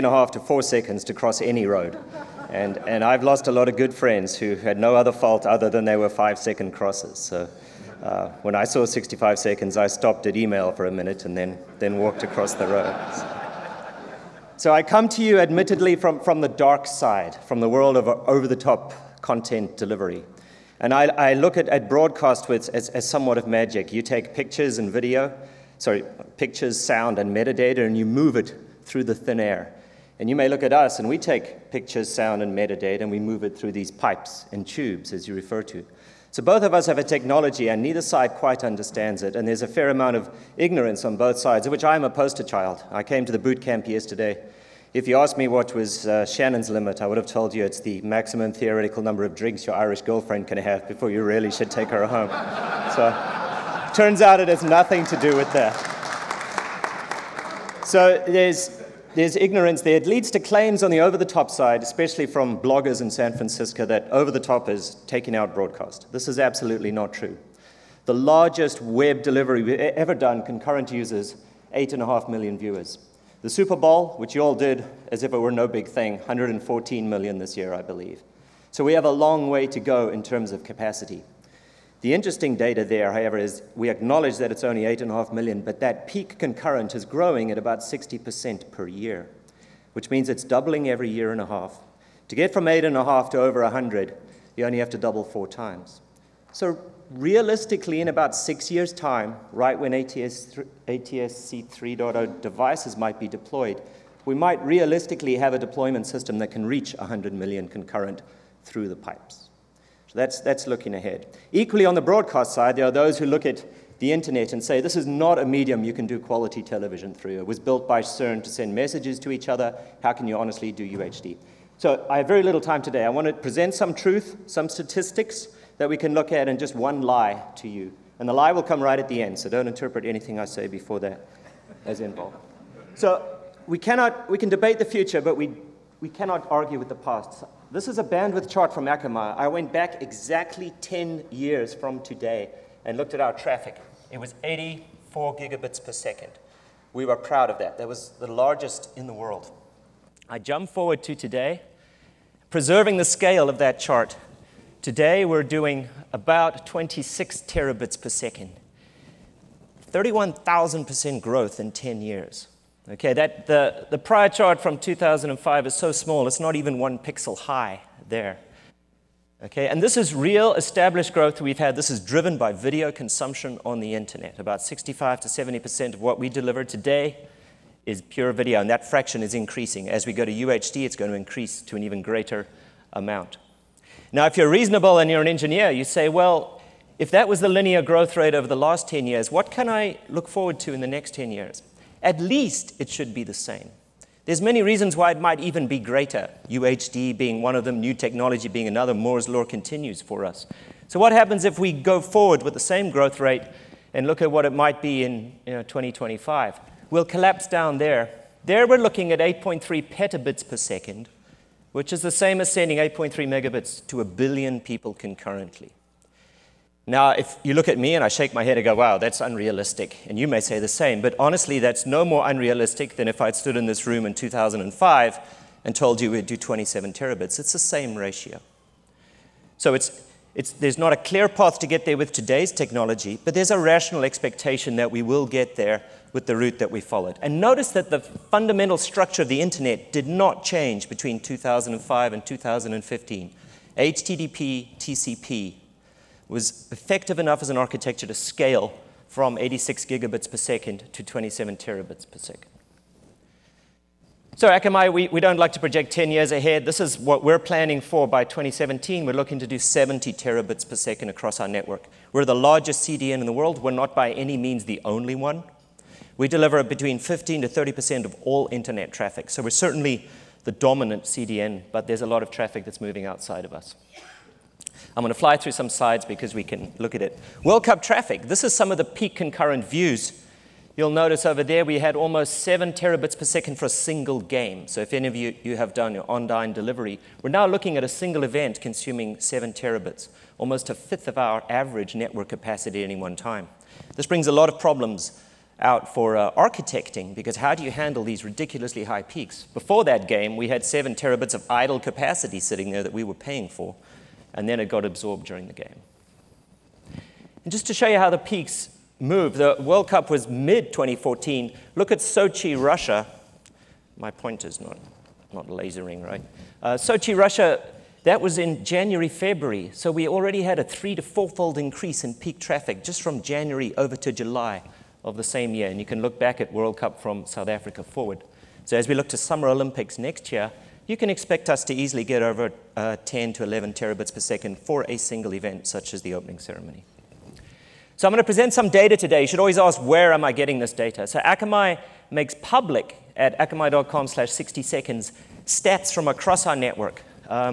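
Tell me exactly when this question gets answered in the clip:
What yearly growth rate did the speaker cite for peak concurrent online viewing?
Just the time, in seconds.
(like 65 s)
87 s.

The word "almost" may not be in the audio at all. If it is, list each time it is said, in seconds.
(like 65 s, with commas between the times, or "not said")
281 s, 290 s.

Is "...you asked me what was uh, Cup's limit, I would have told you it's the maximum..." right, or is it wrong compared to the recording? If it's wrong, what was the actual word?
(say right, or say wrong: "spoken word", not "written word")
wrong: "Shannon", not "Cup".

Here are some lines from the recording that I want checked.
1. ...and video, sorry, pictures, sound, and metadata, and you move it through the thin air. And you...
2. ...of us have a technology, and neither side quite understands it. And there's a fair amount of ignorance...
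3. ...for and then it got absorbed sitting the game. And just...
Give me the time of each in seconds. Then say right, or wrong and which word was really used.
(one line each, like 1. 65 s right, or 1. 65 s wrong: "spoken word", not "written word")
1. 24 s right
2. 36 s right
3. 303 s wrong: "during", not "sitting".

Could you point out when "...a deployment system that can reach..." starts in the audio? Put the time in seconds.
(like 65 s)
105 s.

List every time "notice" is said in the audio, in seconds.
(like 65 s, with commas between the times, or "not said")
237 s, 280 s.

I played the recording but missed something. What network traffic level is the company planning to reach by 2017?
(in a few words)
70 terabits per second.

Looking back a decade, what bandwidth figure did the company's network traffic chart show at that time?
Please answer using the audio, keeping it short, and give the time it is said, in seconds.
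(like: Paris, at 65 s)
84 gigabits per second, at 144 s.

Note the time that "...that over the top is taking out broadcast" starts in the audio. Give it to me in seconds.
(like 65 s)
63 s.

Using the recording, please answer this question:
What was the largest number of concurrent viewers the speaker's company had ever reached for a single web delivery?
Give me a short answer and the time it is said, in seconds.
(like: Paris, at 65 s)
8.5 million, at 71 s.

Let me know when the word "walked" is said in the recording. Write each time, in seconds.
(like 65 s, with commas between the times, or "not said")
11 s.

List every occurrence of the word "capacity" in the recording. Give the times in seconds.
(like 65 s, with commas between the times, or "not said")
80 s, 292 s, 301 s.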